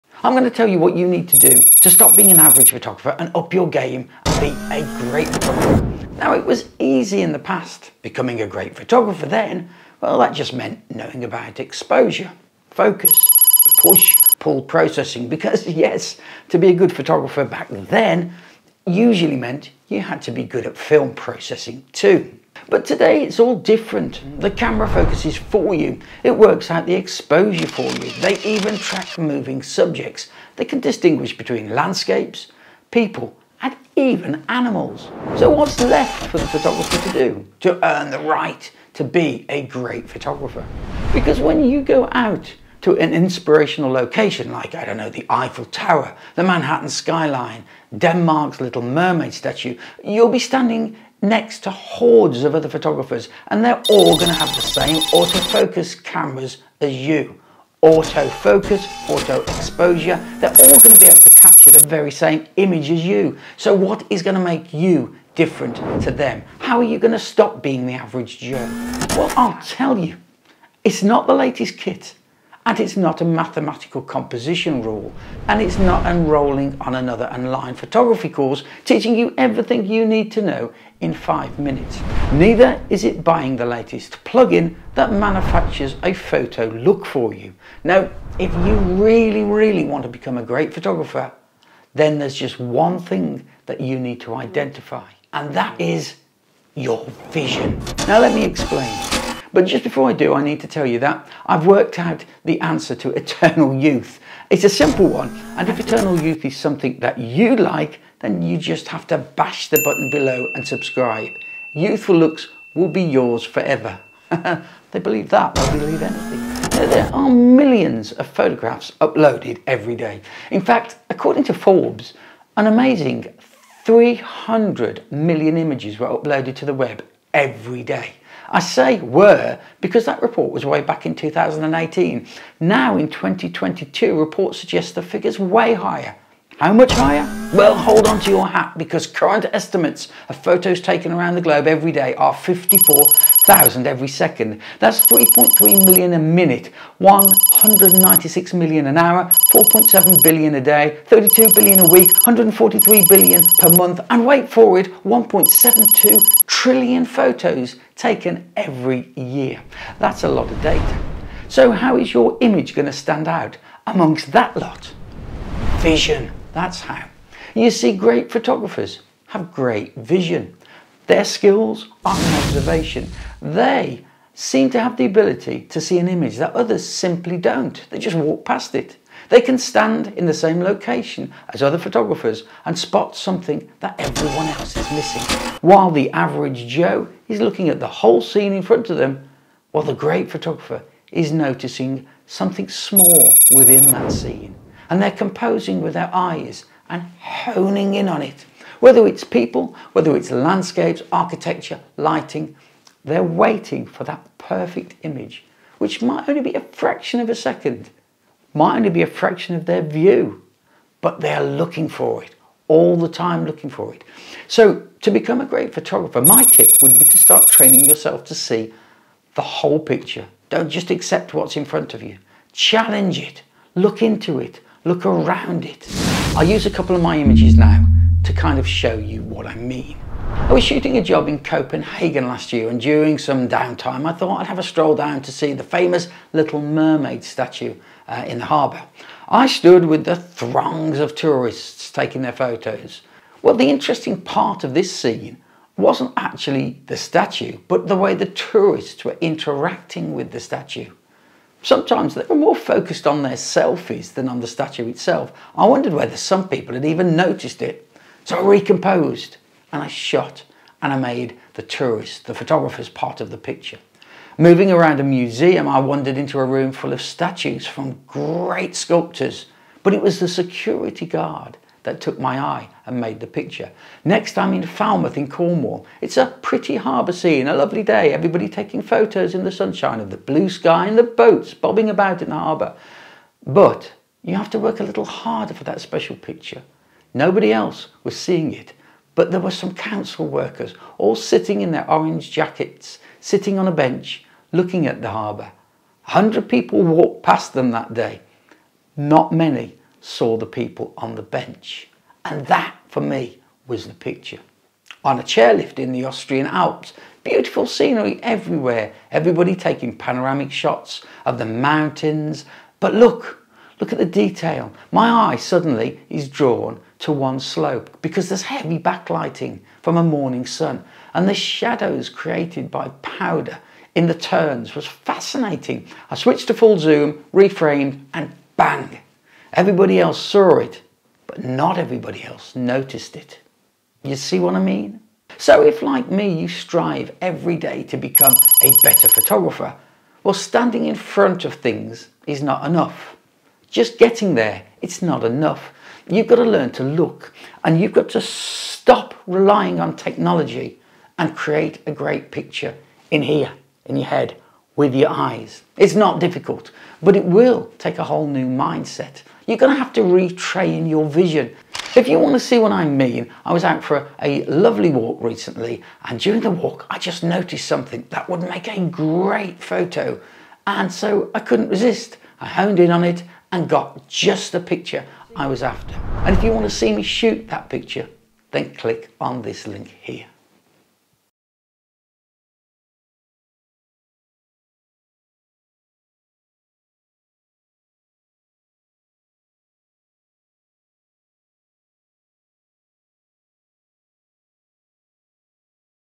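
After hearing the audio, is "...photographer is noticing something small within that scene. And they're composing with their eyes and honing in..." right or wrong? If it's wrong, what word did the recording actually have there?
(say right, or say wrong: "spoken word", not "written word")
right.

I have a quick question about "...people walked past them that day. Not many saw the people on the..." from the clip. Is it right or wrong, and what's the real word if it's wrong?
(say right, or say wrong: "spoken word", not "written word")
right.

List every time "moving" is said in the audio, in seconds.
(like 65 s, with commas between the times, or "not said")
29 s, 264 s.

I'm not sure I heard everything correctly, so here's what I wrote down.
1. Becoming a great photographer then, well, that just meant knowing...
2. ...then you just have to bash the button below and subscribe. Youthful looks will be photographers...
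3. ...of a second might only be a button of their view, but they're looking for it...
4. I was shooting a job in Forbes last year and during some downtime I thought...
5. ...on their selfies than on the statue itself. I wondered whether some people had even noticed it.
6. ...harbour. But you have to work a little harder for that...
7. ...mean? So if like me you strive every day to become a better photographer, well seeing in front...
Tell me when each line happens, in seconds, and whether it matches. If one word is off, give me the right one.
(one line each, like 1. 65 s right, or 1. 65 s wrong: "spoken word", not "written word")
1. 8 s right
2. 108 s wrong: "yours", not "photographers"
3. 207 s wrong: "fraction", not "button"
4. 230 s wrong: "Copenhagen", not "Forbes"
5. 253 s right
6. 282 s right
7. 334 s wrong: "standing", not "seeing".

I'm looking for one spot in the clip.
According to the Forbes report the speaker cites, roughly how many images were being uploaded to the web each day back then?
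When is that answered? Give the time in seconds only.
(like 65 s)
123 s.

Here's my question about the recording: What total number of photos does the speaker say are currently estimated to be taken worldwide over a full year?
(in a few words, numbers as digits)
1.72 trillion.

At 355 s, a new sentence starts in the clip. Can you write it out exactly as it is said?
It's not difficult, but it will take a whole new mindset.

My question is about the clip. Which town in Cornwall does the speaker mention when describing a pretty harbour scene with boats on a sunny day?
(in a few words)
Falmouth.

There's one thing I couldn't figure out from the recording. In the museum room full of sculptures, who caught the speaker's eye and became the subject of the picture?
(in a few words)
the security guard.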